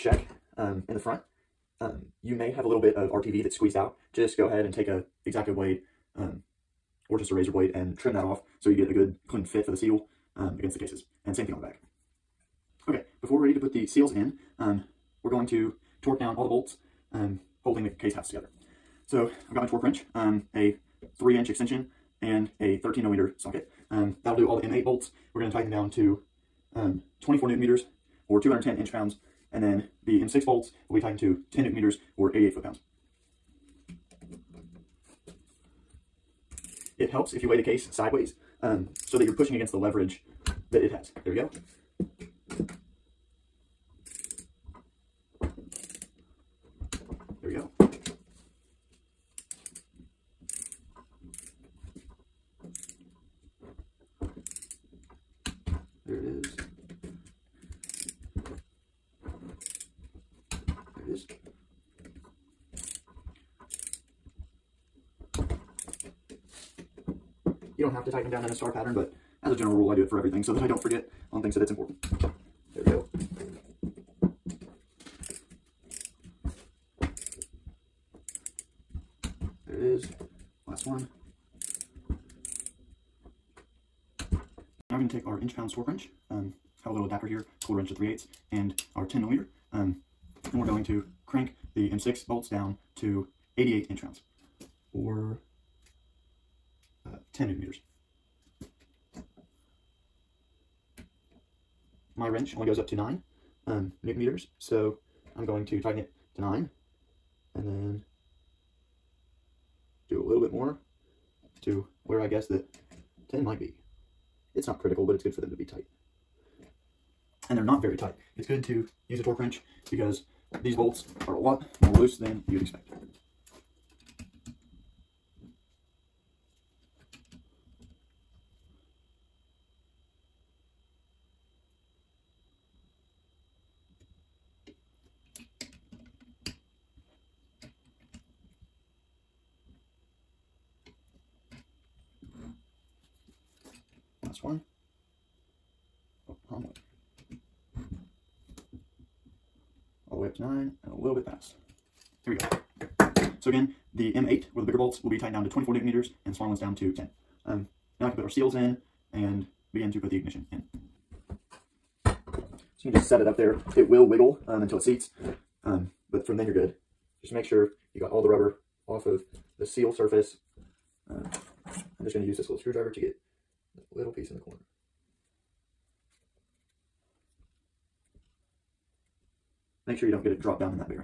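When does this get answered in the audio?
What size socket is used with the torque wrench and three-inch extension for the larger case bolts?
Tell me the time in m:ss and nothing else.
0:22.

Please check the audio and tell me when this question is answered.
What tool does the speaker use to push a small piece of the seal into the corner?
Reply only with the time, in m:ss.
2:52.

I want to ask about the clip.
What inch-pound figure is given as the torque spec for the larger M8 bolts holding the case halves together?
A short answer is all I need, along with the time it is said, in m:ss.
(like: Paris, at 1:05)
210 inch pounds, at 0:28.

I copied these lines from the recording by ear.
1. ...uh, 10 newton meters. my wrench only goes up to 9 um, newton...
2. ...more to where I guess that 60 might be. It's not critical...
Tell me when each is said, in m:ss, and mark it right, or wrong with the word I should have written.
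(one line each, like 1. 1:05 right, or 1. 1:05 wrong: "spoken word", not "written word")
1. 1:37 right
2. 1:50 wrong: "10", not "60".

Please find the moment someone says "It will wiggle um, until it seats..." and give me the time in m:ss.
2:43.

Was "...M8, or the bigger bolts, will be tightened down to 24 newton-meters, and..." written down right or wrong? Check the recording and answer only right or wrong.
right.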